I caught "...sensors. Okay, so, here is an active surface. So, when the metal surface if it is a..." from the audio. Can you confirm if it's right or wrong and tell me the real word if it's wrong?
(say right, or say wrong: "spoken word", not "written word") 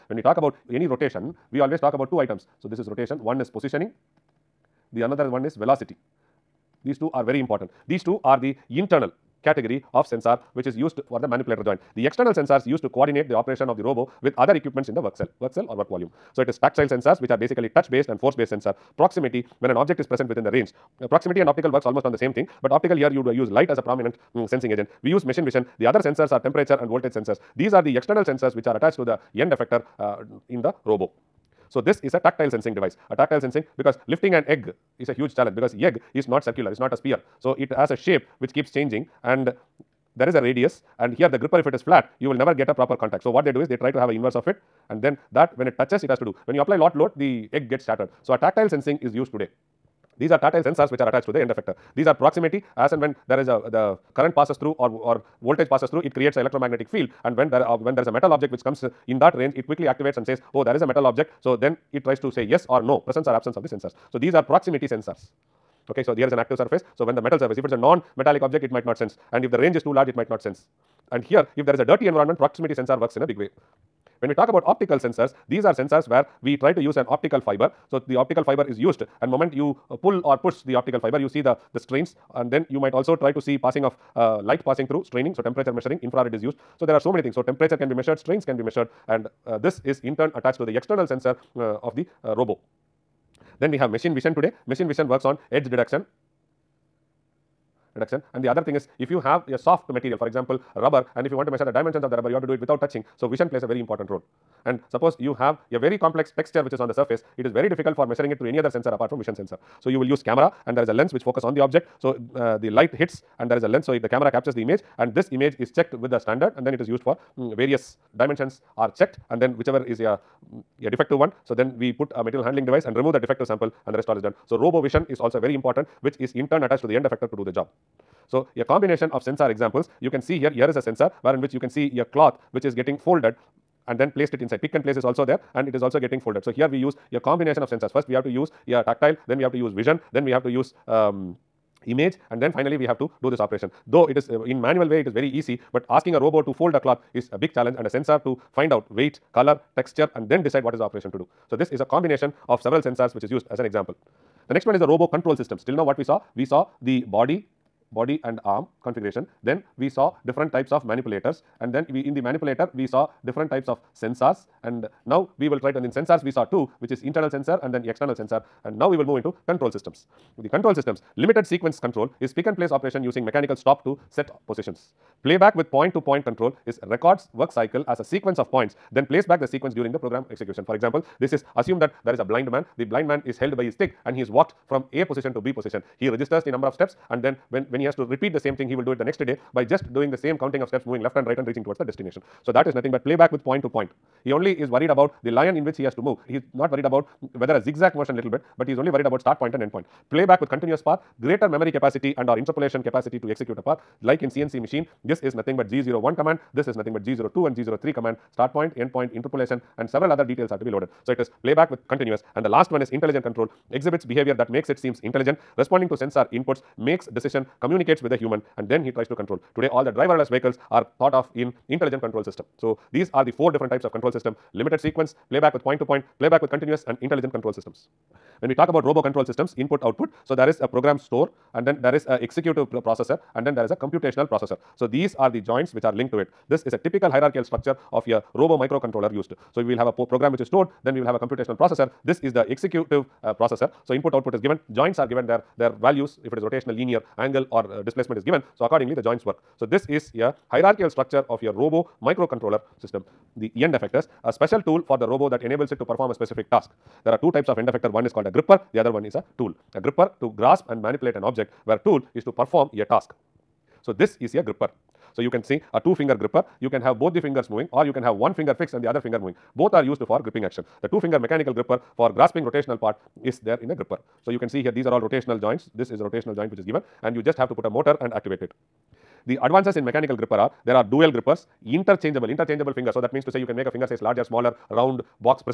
right.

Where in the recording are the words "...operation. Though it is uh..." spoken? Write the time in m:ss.
2:23.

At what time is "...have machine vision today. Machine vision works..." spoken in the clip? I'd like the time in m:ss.
1:33.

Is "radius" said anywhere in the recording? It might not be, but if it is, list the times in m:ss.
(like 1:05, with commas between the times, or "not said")
0:40.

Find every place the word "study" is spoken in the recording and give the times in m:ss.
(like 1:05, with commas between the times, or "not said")
not said.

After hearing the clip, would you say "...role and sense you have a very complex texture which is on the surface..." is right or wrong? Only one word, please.
wrong.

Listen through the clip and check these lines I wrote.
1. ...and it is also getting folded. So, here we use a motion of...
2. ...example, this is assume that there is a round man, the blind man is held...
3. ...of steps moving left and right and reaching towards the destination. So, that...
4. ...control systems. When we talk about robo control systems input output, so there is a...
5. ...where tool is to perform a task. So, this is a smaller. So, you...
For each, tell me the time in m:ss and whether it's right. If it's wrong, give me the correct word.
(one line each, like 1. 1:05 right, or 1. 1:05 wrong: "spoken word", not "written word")
1. 2:15 wrong: "combination", not "motion"
2. 3:00 wrong: "blind", not "round"
3. 3:10 right
4. 3:47 right
5. 4:21 wrong: "gripper", not "smaller".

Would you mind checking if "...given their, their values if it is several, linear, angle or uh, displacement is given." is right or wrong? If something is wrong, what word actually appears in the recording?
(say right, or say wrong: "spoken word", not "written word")
wrong: "rotational", not "several".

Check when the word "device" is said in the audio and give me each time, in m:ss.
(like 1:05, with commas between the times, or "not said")
0:32, 2:02.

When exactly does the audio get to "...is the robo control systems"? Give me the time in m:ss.
2:34.